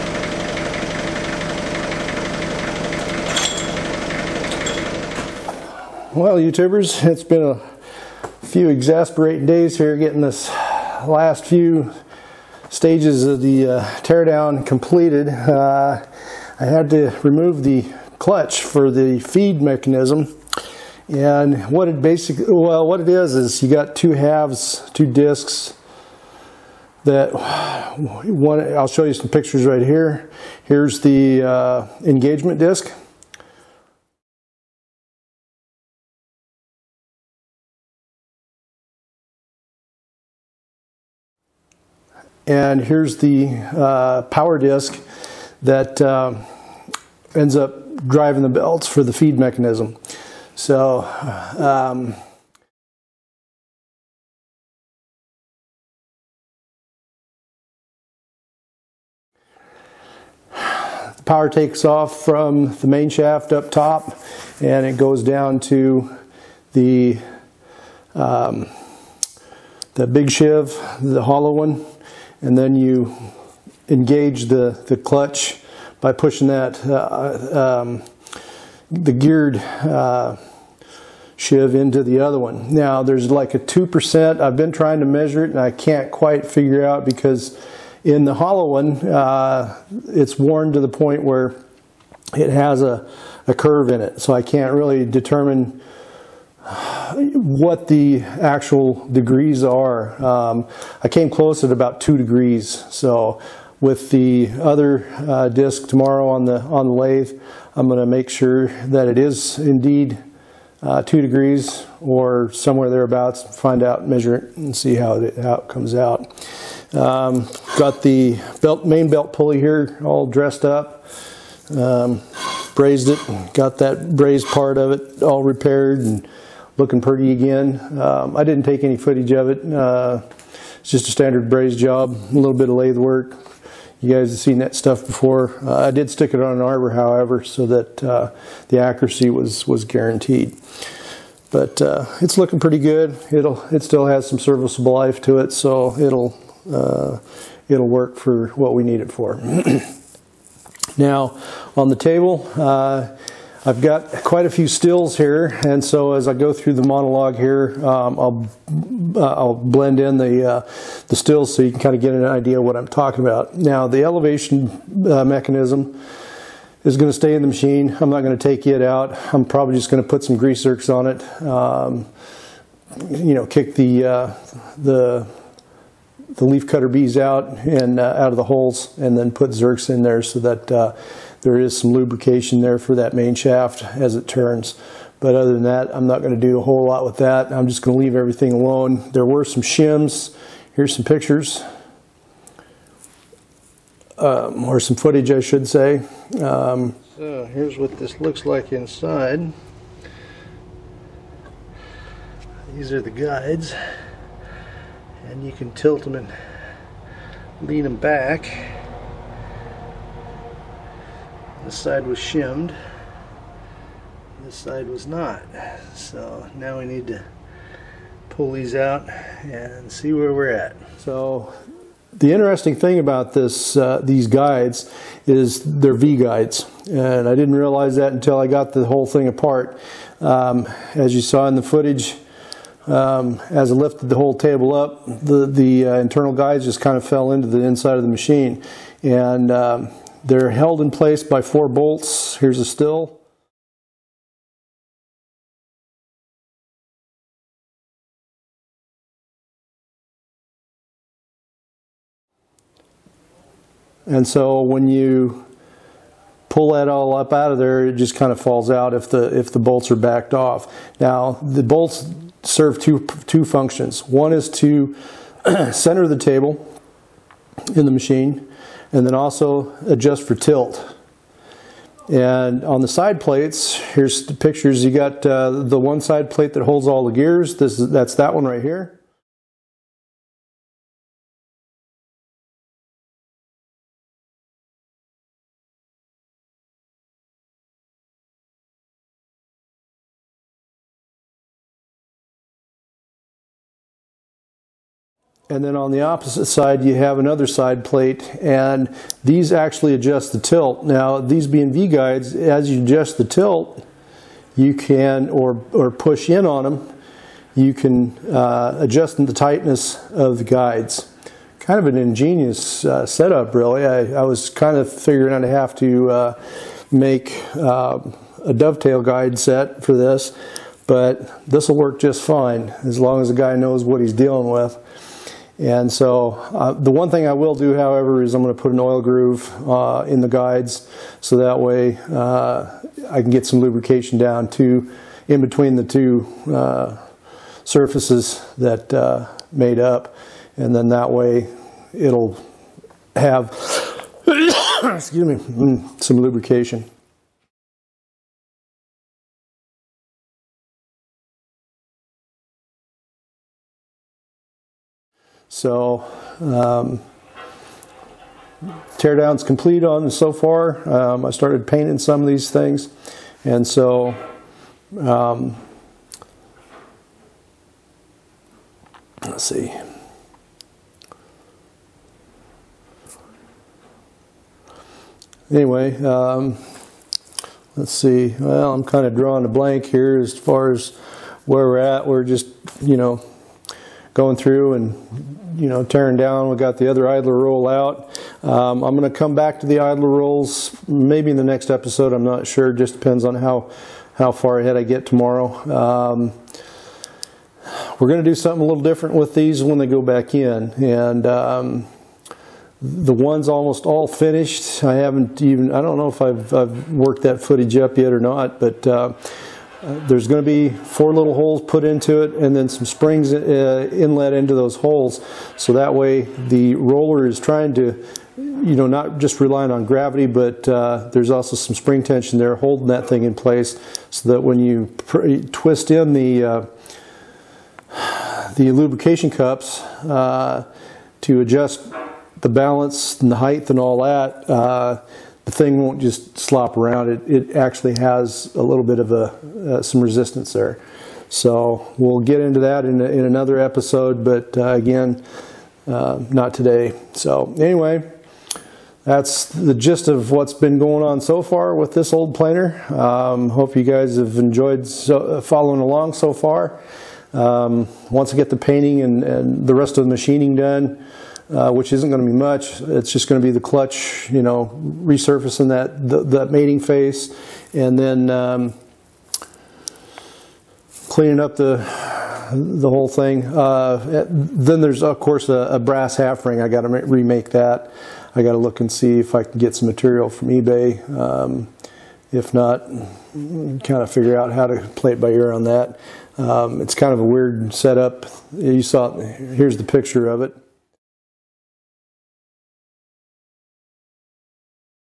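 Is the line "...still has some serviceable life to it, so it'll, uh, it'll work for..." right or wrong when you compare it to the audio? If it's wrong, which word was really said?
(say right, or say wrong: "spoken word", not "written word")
right.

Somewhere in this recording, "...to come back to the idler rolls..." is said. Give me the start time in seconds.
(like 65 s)
389 s.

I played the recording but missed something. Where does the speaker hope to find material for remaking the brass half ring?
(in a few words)
eBay.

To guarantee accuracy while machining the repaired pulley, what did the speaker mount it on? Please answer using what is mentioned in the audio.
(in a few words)
An arbor.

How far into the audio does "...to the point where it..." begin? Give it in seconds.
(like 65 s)
90 s.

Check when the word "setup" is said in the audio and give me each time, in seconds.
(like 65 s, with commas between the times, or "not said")
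313 s, 487 s.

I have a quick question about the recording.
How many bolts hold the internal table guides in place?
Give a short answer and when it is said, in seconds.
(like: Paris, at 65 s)
4, at 241 s.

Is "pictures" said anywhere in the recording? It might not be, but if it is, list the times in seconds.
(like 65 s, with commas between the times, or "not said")
29 s, 191 s, 274 s, 489 s.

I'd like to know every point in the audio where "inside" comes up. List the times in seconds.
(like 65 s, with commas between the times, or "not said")
198 s, 237 s.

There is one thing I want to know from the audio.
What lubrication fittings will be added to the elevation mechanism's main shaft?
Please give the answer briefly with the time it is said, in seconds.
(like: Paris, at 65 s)
Grease zerks, at 170 s.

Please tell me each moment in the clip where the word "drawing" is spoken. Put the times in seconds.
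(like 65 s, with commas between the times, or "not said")
379 s.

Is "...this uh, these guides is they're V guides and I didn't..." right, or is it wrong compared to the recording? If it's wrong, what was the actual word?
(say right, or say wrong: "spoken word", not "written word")
right.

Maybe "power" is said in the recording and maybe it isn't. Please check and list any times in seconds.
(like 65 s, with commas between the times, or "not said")
44 s, 61 s.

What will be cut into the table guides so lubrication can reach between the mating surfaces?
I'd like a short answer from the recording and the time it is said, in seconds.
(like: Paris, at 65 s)
An oil groove, at 328 s.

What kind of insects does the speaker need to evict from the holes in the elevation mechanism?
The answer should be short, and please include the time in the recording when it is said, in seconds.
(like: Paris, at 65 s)
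Leaf cutter bees, at 176 s.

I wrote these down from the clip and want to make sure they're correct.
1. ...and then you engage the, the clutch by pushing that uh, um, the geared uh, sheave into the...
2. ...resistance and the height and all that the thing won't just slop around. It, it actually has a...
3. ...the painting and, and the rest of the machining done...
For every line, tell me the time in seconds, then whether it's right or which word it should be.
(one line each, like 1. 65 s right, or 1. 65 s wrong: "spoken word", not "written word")
1. 72 s right
2. 432 s wrong: "balance", not "resistance"
3. 458 s right.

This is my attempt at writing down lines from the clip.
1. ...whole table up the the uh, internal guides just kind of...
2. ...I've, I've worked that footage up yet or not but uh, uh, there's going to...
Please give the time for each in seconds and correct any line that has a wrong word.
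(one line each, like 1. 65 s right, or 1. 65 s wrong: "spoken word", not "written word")
1. 234 s right
2. 406 s right.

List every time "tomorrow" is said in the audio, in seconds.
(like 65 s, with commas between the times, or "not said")
105 s, 395 s.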